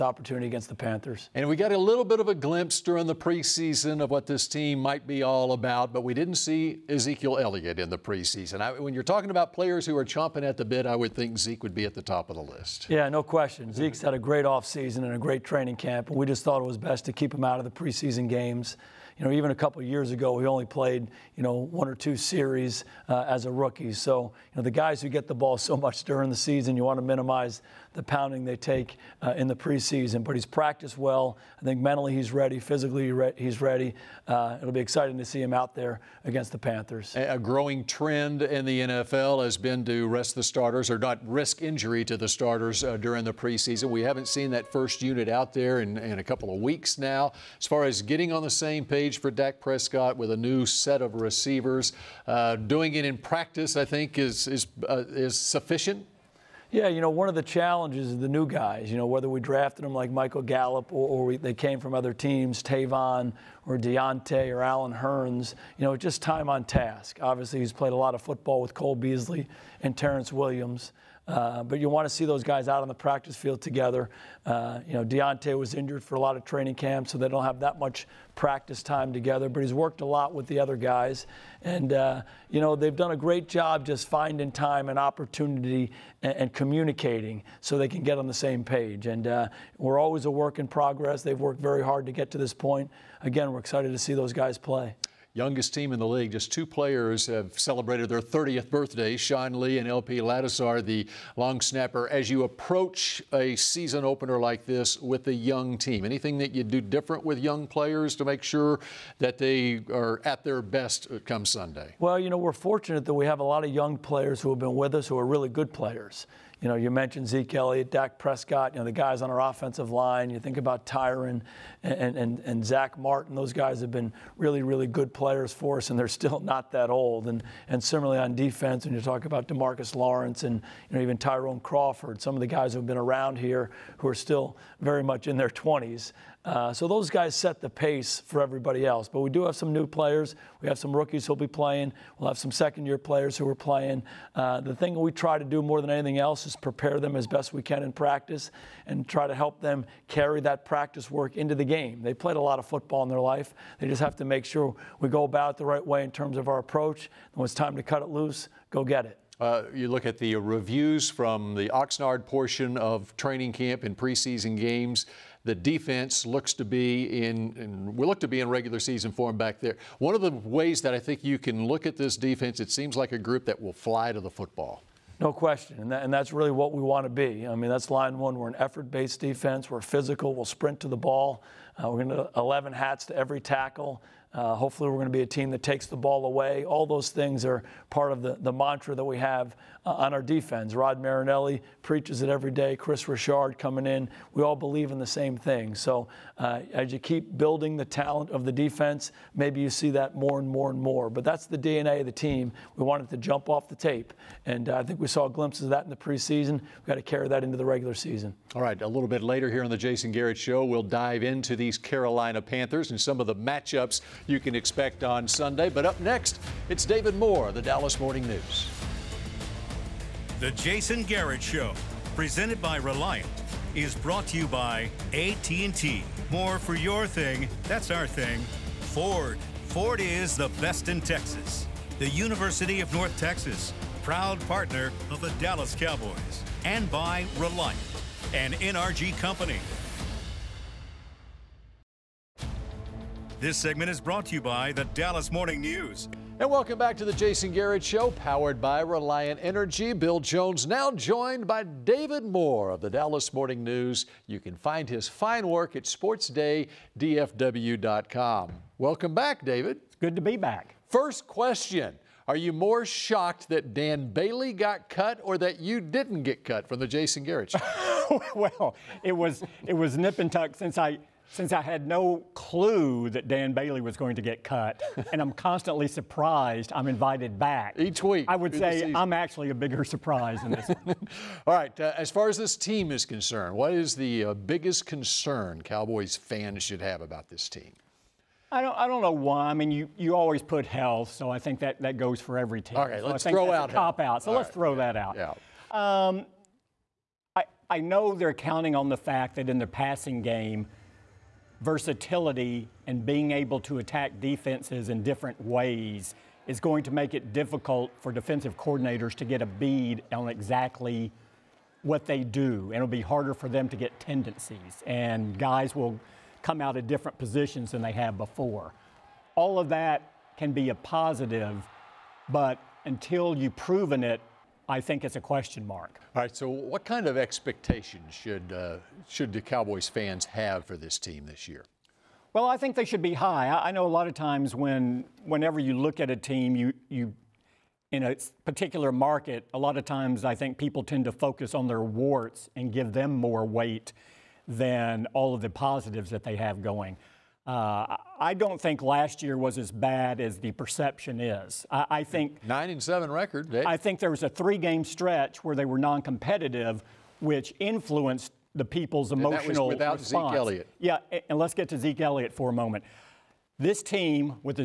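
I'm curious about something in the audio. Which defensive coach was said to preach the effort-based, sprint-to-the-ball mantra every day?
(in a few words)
Rod Marinelli.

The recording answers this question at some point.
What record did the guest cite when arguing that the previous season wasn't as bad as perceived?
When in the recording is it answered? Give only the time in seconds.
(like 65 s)
352 s.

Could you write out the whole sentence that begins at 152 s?
They played a lot of football in their life.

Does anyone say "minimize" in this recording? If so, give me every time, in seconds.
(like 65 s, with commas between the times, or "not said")
27 s.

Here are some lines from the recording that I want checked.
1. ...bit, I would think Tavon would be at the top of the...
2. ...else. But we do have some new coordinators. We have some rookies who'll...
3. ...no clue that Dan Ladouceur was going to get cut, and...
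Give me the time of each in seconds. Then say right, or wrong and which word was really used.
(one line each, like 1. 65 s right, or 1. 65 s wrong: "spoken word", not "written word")
1. 10 s wrong: "Zeke", not "Tavon"
2. 138 s wrong: "players", not "coordinators"
3. 271 s wrong: "Bailey", not "Ladouceur".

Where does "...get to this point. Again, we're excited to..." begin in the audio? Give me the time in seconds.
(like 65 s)
92 s.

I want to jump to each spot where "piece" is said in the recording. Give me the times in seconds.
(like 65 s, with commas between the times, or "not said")
not said.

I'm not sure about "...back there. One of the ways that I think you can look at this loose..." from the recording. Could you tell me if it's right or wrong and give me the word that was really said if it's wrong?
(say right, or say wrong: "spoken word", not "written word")
wrong: "defense", not "loose".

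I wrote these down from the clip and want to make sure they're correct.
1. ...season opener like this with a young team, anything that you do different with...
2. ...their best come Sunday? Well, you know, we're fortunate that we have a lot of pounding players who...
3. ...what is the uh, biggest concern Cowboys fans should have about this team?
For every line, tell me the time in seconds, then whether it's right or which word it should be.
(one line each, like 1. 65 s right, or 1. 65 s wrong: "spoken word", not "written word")
1. 103 s right
2. 110 s wrong: "young", not "pounding"
3. 283 s right.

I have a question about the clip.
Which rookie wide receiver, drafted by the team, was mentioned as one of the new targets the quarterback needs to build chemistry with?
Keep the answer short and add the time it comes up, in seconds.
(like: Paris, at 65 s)
Michael Gallup, at 60 s.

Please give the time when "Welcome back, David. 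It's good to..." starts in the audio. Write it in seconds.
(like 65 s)
258 s.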